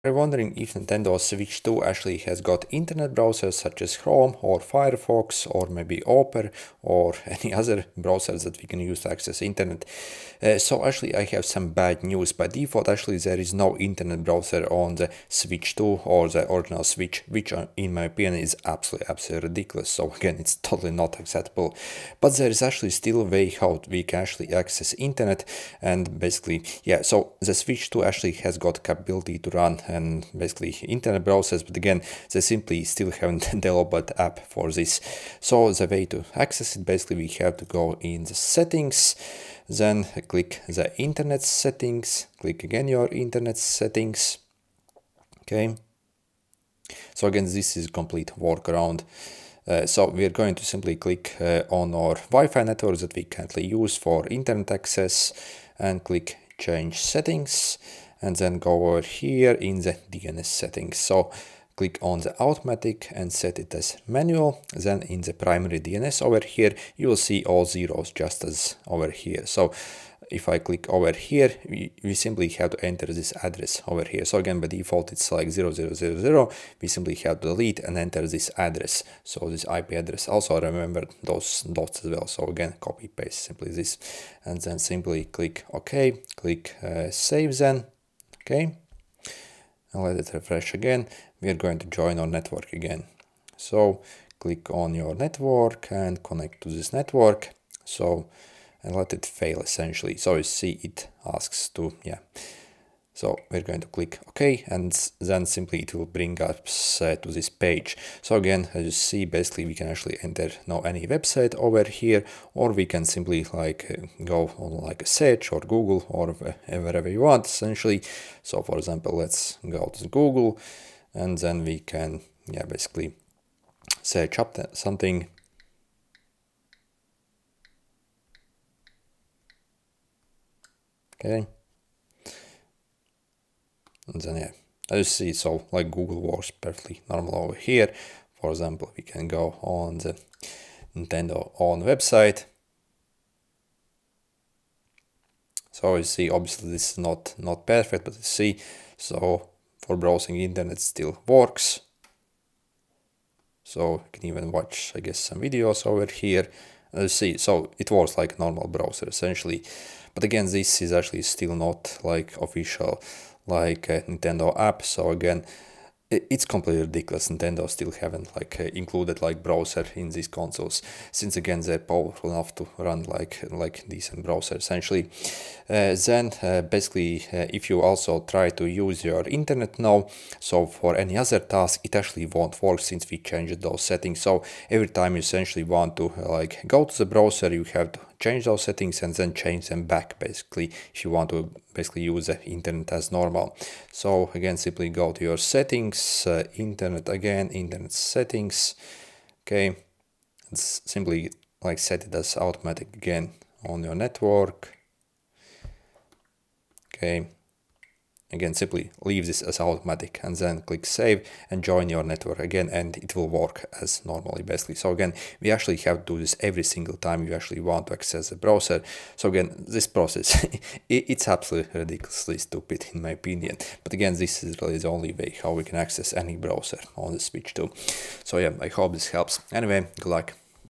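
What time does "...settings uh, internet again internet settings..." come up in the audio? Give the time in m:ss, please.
3:15.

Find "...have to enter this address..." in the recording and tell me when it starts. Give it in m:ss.
1:12.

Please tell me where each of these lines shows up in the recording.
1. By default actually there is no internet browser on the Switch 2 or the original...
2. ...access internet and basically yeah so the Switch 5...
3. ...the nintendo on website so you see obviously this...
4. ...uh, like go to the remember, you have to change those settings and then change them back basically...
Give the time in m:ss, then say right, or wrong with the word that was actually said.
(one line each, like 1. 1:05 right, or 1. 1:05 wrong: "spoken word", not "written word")
1. 0:12 right
2. 0:24 wrong: "2", not "5"
3. 2:19 right
4. 3:06 wrong: "browser", not "remember".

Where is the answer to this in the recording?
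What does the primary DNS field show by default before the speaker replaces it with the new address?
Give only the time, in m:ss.
1:07.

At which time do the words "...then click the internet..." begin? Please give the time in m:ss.
0:39.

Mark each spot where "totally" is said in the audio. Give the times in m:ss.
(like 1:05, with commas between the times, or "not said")
0:20.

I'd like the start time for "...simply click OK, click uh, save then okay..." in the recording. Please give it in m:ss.
1:24.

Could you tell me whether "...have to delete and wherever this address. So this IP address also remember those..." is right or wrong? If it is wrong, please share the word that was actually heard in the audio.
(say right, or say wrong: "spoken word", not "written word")
wrong: "enter", not "wherever".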